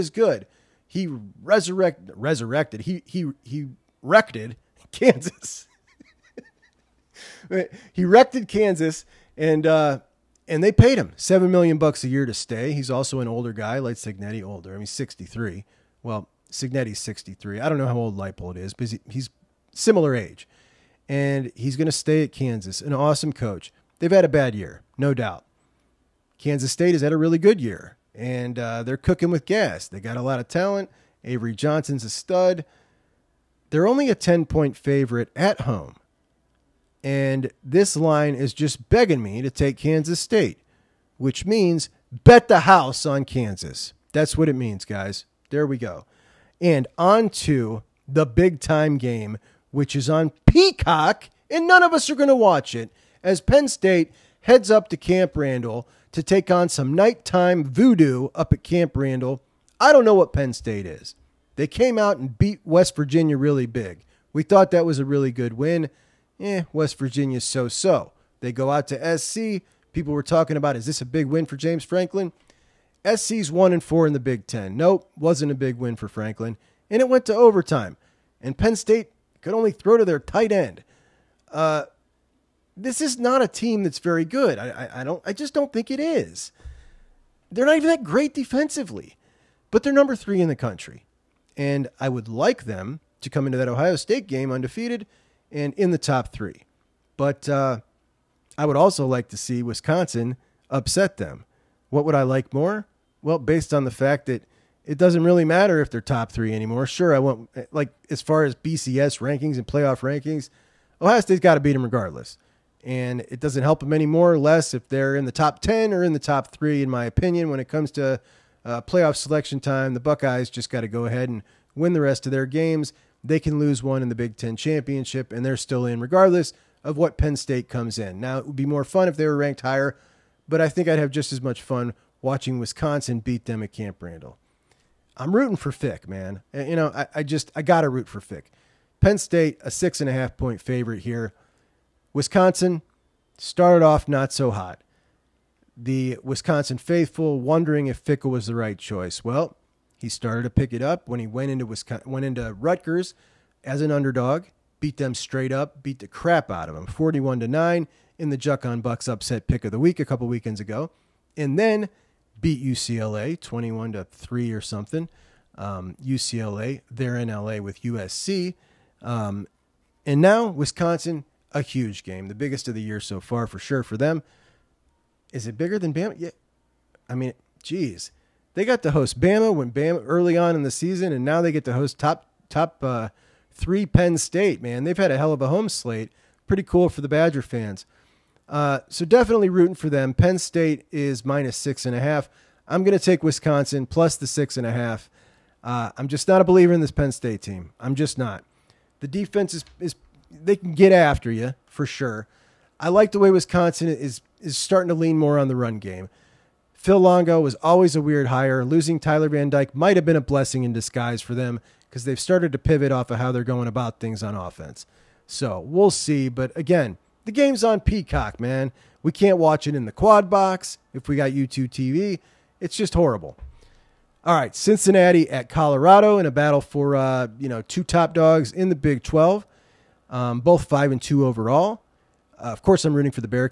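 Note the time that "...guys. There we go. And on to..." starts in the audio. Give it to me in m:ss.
0:44.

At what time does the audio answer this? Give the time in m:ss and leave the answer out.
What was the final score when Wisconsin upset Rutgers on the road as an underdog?
2:36.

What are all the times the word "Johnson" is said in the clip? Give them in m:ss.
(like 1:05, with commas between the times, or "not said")
0:31.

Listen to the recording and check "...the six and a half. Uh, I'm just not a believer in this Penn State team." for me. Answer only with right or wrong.
right.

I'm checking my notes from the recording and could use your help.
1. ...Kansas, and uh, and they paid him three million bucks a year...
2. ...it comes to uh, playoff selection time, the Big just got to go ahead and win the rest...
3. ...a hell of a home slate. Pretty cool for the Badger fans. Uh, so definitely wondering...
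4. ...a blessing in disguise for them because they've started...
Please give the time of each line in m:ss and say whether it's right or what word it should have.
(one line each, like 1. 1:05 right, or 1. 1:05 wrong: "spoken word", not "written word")
1. 0:08 wrong: "seven", not "three"
2. 1:57 wrong: "Buckeyes", not "Big"
3. 3:05 wrong: "rooting", not "wondering"
4. 3:30 right.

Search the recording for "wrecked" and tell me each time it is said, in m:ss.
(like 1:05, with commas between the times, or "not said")
0:04, 0:08.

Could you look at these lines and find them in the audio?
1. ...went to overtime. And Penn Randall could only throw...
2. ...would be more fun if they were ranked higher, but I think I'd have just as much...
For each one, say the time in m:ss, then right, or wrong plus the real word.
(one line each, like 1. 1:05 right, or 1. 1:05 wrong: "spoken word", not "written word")
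1. 1:17 wrong: "State", not "Randall"
2. 2:08 right.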